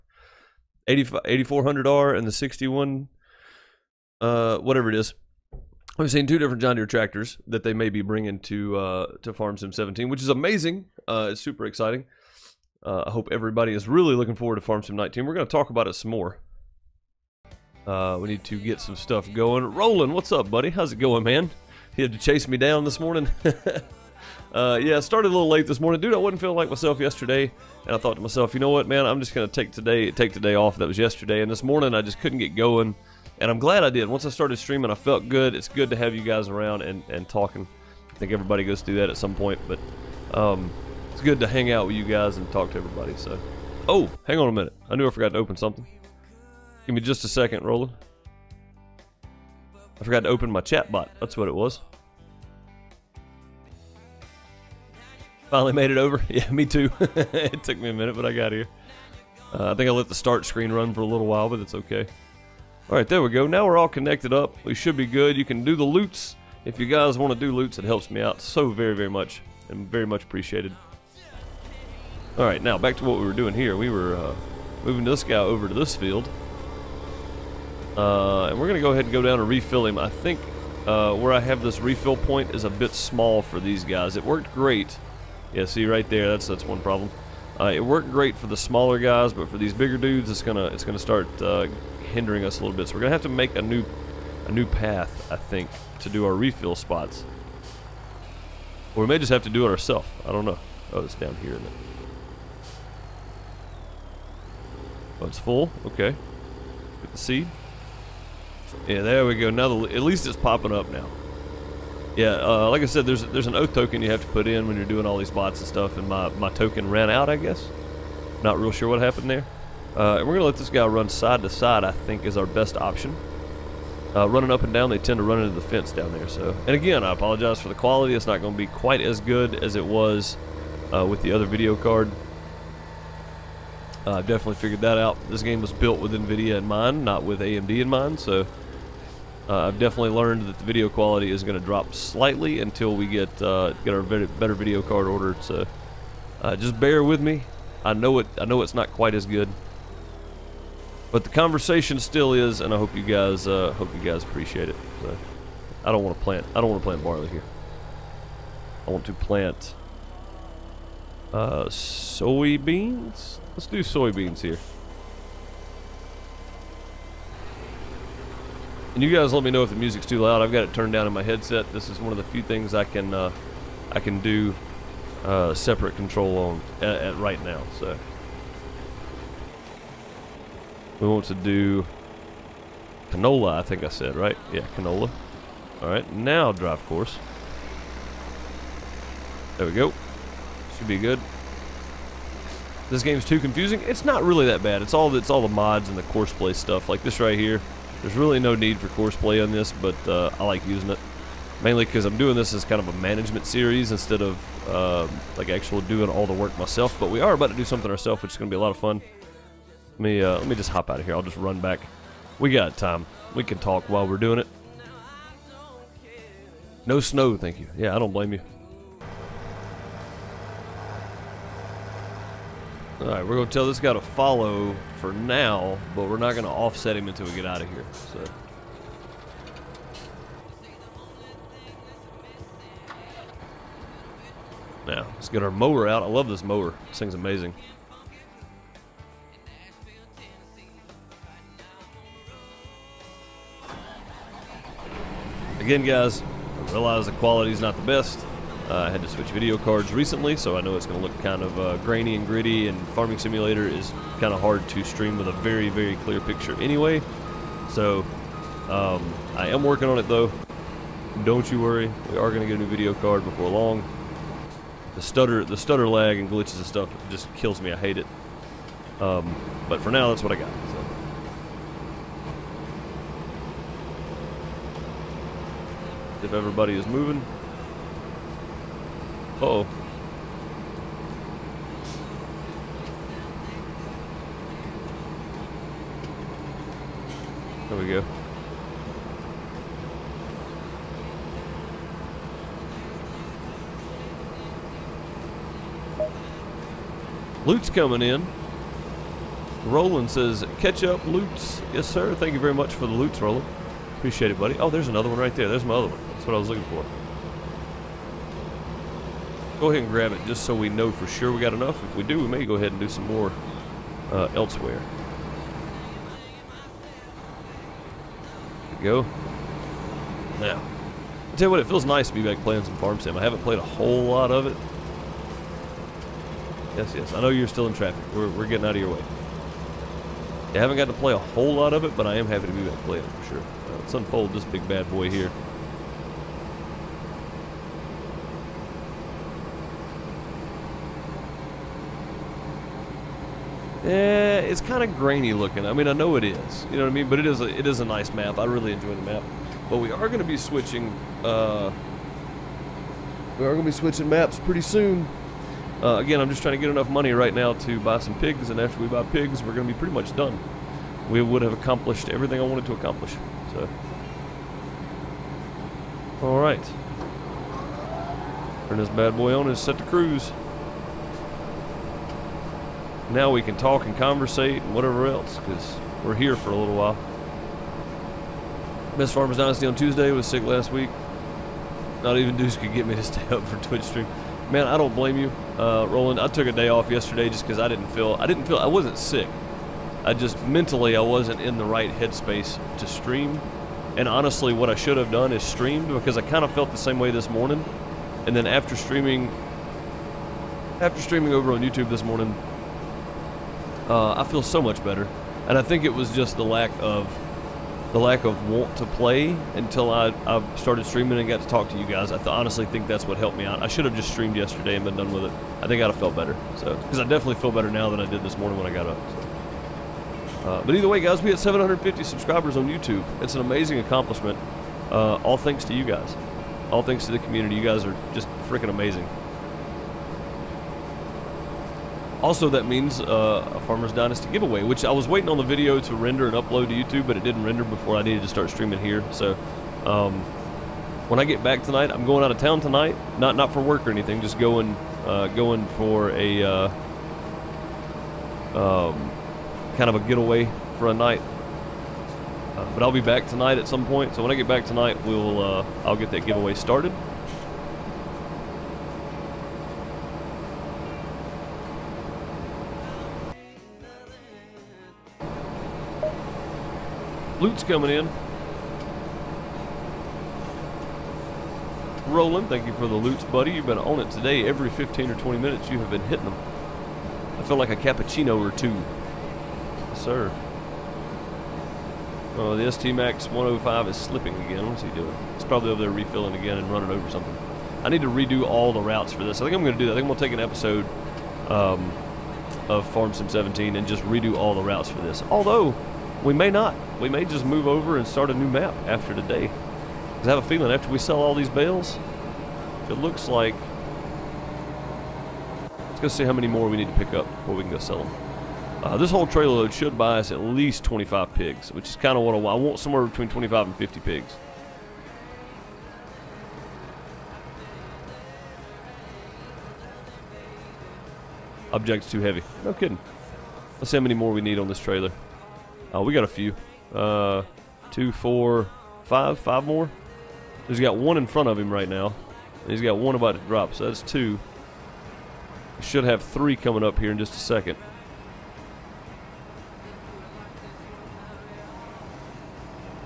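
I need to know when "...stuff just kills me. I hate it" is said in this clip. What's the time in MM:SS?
04:26.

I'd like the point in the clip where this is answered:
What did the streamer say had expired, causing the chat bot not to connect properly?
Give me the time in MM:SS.
01:53.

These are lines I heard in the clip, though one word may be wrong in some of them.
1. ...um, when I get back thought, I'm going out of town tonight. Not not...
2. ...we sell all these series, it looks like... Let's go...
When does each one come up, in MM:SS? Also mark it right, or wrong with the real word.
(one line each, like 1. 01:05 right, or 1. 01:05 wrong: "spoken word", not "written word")
1. 07:19 wrong: "tonight", not "thought"
2. 08:20 wrong: "bales", not "series".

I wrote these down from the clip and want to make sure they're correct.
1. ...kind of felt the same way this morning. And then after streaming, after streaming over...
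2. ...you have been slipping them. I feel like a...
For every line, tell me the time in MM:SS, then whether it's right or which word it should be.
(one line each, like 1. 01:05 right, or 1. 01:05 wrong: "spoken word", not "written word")
1. 06:36 right
2. 07:55 wrong: "hitting", not "slipping".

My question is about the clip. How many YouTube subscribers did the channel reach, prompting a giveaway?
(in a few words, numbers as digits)
750.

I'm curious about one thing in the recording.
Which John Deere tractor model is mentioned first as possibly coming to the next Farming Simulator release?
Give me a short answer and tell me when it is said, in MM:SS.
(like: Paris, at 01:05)
8400R, at 00:00.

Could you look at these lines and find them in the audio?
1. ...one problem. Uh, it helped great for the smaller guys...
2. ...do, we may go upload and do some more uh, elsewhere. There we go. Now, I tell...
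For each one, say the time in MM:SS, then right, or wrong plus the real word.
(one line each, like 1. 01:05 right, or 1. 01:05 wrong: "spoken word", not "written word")
1. 01:26 wrong: "worked", not "helped"
2. 05:12 wrong: "ahead", not "upload".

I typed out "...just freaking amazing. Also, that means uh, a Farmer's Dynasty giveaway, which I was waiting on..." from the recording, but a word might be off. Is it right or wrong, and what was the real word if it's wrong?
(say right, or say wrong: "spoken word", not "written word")
right.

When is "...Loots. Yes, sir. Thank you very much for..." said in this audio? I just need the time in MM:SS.
05:01.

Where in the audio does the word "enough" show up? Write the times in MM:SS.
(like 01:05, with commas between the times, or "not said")
05:11, 05:56.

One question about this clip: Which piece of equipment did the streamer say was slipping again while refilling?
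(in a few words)
ST Max 105.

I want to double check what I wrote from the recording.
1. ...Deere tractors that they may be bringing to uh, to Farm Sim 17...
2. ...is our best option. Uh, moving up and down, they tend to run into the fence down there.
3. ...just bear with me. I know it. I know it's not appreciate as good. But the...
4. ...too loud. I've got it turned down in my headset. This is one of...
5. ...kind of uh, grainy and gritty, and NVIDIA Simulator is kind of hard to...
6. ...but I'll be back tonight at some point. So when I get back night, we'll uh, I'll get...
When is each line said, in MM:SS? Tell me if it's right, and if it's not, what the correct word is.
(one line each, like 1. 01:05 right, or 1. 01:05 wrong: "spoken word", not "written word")
1. 00:06 right
2. 02:02 wrong: "running", not "moving"
3. 02:26 wrong: "quite", not "appreciate"
4. 02:50 right
5. 04:11 wrong: "Farming", not "NVIDIA"
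6. 07:32 wrong: "tonight", not "night".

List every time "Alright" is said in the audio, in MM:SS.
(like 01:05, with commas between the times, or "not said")
01:02, 01:12, 03:05, 03:42.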